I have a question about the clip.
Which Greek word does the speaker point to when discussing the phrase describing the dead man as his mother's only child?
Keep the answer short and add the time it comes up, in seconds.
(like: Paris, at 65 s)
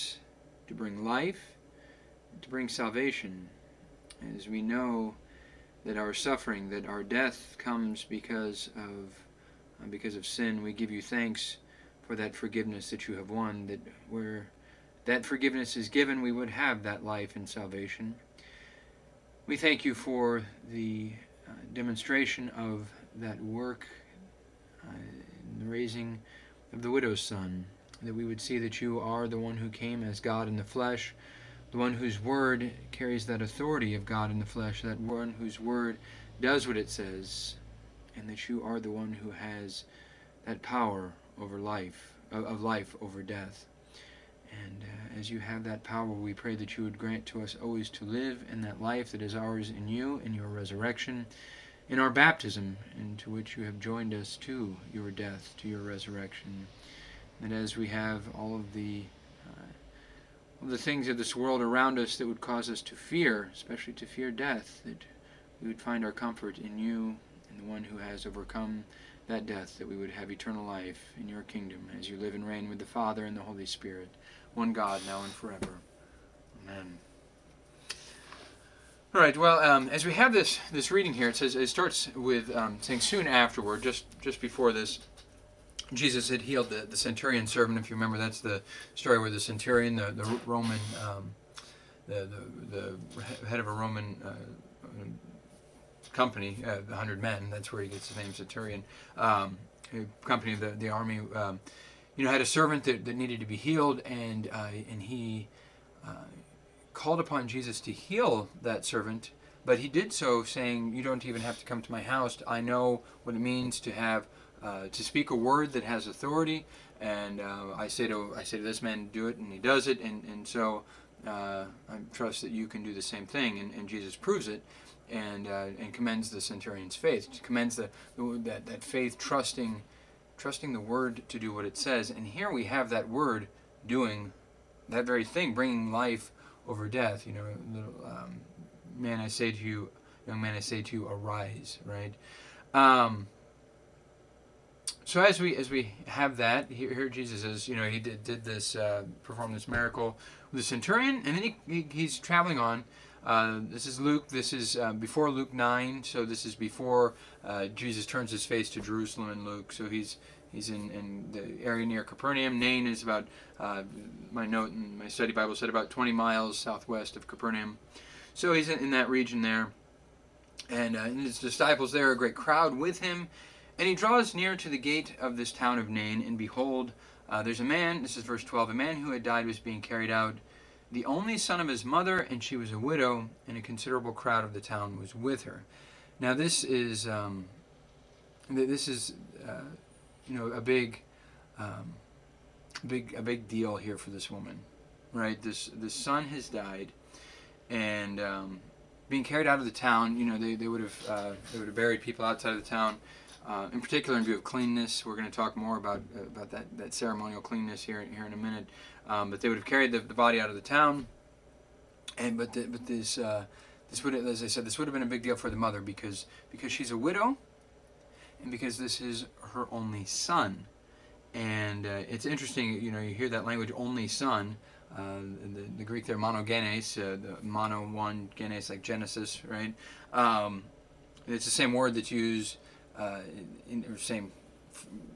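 monogenes, at 226 s.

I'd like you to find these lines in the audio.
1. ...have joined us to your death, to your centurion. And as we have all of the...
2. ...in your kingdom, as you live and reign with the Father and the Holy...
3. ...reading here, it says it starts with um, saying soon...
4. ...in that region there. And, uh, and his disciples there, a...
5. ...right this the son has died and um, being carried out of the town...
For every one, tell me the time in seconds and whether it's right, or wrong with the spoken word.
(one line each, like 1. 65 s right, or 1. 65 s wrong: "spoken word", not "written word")
1. 53 s wrong: "resurrection", not "centurion"
2. 71 s right
3. 80 s right
4. 168 s right
5. 195 s right.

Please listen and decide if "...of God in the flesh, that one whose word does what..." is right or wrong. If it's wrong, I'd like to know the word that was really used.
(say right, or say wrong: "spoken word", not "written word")
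right.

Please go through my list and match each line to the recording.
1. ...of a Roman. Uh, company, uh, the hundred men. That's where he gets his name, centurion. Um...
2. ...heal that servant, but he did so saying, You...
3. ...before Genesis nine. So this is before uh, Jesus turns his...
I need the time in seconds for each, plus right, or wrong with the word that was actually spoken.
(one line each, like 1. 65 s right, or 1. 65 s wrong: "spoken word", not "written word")
1. 93 s right
2. 107 s right
3. 154 s wrong: "Luke", not "Genesis".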